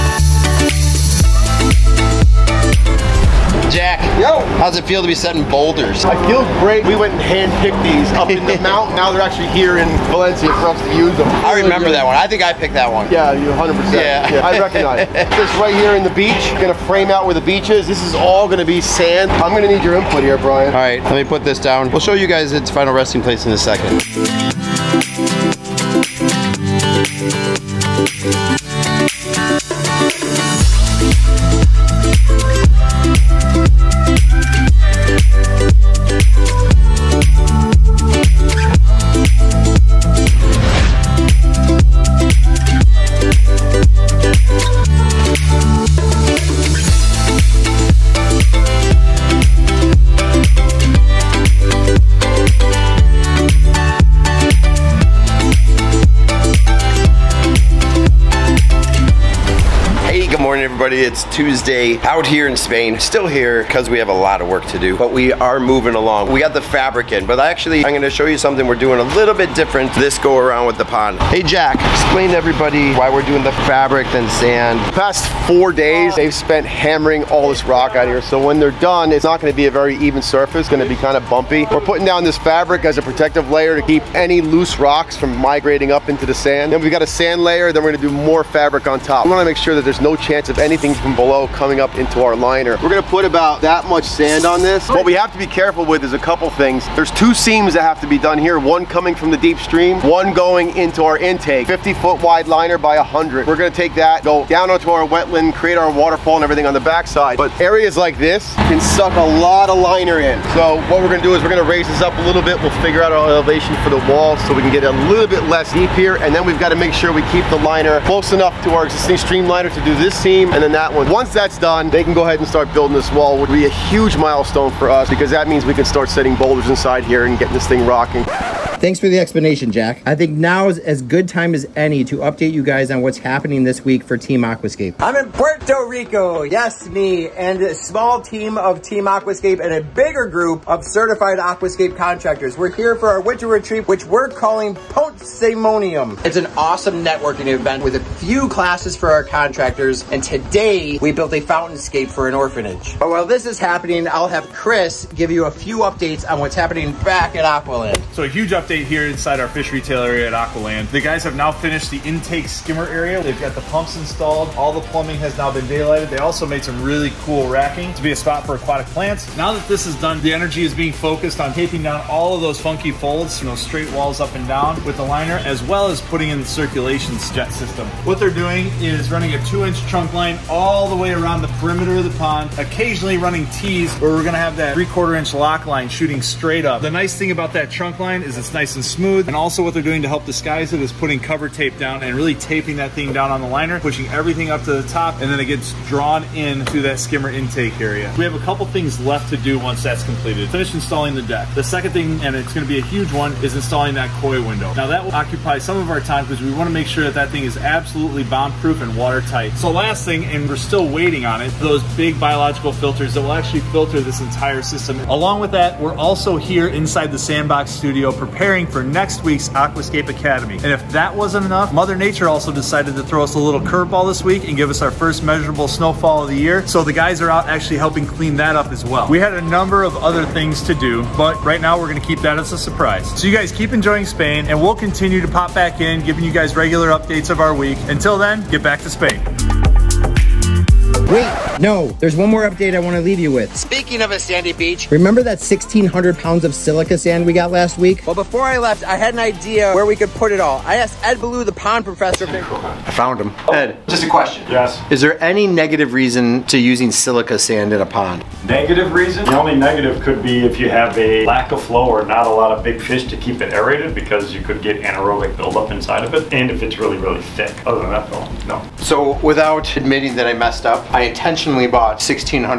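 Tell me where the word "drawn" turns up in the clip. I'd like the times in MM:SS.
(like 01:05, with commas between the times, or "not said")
03:15.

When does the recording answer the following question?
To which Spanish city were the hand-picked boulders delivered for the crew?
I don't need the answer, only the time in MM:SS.
00:10.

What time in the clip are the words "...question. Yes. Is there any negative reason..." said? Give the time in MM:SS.
04:14.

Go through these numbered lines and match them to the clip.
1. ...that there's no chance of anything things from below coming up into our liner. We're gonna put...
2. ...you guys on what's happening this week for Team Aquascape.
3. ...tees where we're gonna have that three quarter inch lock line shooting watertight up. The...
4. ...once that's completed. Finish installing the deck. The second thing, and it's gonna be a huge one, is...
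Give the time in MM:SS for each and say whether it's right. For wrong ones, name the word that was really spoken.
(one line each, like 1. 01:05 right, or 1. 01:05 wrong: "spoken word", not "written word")
1. 01:29 right
2. 02:12 right
3. 03:03 wrong: "straight", not "watertight"
4. 03:19 right.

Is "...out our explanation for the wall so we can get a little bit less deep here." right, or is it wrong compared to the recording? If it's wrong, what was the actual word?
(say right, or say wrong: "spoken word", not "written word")
wrong: "elevation", not "explanation".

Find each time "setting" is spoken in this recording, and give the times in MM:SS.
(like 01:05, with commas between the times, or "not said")
00:05, 02:06.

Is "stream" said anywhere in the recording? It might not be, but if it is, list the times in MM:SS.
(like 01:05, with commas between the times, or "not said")
01:39, 01:59.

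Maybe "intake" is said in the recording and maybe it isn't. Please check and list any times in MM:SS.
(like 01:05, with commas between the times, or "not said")
01:41, 02:41, 03:17.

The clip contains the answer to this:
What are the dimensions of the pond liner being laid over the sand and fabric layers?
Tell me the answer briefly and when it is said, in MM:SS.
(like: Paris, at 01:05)
50 by 100 feet, at 01:41.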